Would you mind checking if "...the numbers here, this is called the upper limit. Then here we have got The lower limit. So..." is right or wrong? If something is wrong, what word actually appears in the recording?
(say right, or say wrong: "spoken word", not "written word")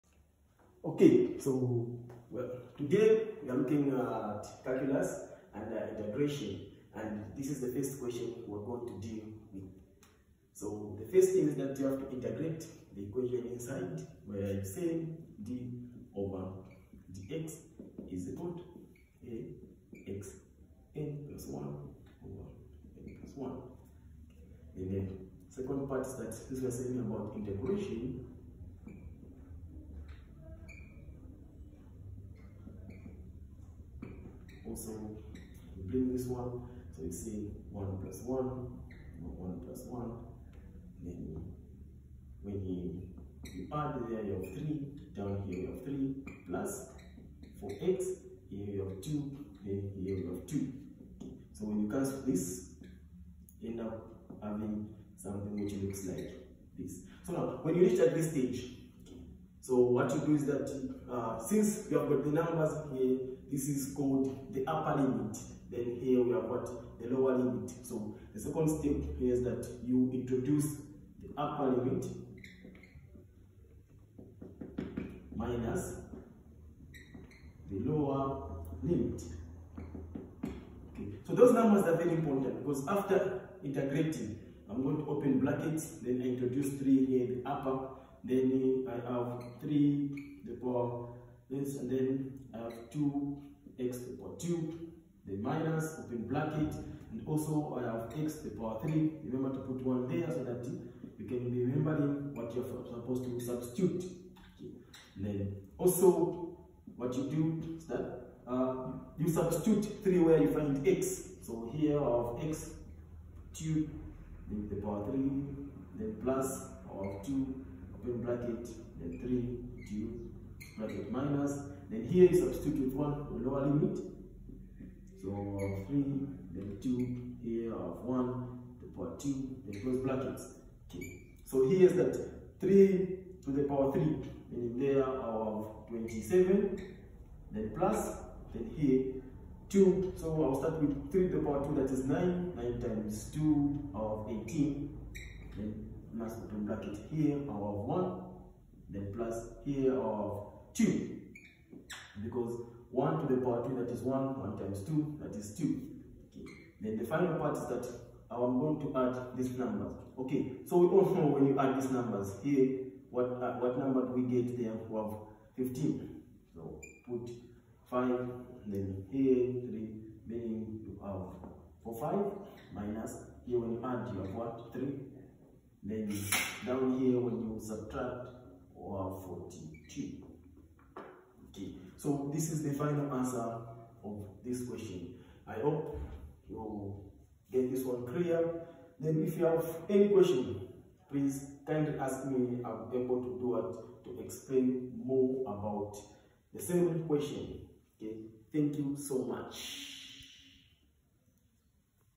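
right.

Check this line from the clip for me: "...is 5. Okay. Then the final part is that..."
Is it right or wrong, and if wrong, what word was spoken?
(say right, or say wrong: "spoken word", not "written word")
wrong: "2", not "5".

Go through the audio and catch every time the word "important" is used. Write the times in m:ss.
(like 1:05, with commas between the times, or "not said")
1:22.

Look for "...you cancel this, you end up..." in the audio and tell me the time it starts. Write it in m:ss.
0:51.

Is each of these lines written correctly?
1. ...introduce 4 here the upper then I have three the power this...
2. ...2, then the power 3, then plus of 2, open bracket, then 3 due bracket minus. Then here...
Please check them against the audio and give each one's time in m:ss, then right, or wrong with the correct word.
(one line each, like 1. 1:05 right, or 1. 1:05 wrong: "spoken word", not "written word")
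1. 1:26 wrong: "3", not "4"
2. 1:53 right.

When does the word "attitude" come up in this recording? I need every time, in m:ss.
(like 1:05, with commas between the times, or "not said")
not said.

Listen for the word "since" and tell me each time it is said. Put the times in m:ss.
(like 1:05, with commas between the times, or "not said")
1:01.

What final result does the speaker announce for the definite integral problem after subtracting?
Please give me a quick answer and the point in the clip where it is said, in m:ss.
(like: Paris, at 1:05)
42, at 2:59.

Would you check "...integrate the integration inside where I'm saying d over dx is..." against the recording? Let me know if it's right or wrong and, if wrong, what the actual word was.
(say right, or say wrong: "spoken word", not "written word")
wrong: "equation", not "integration".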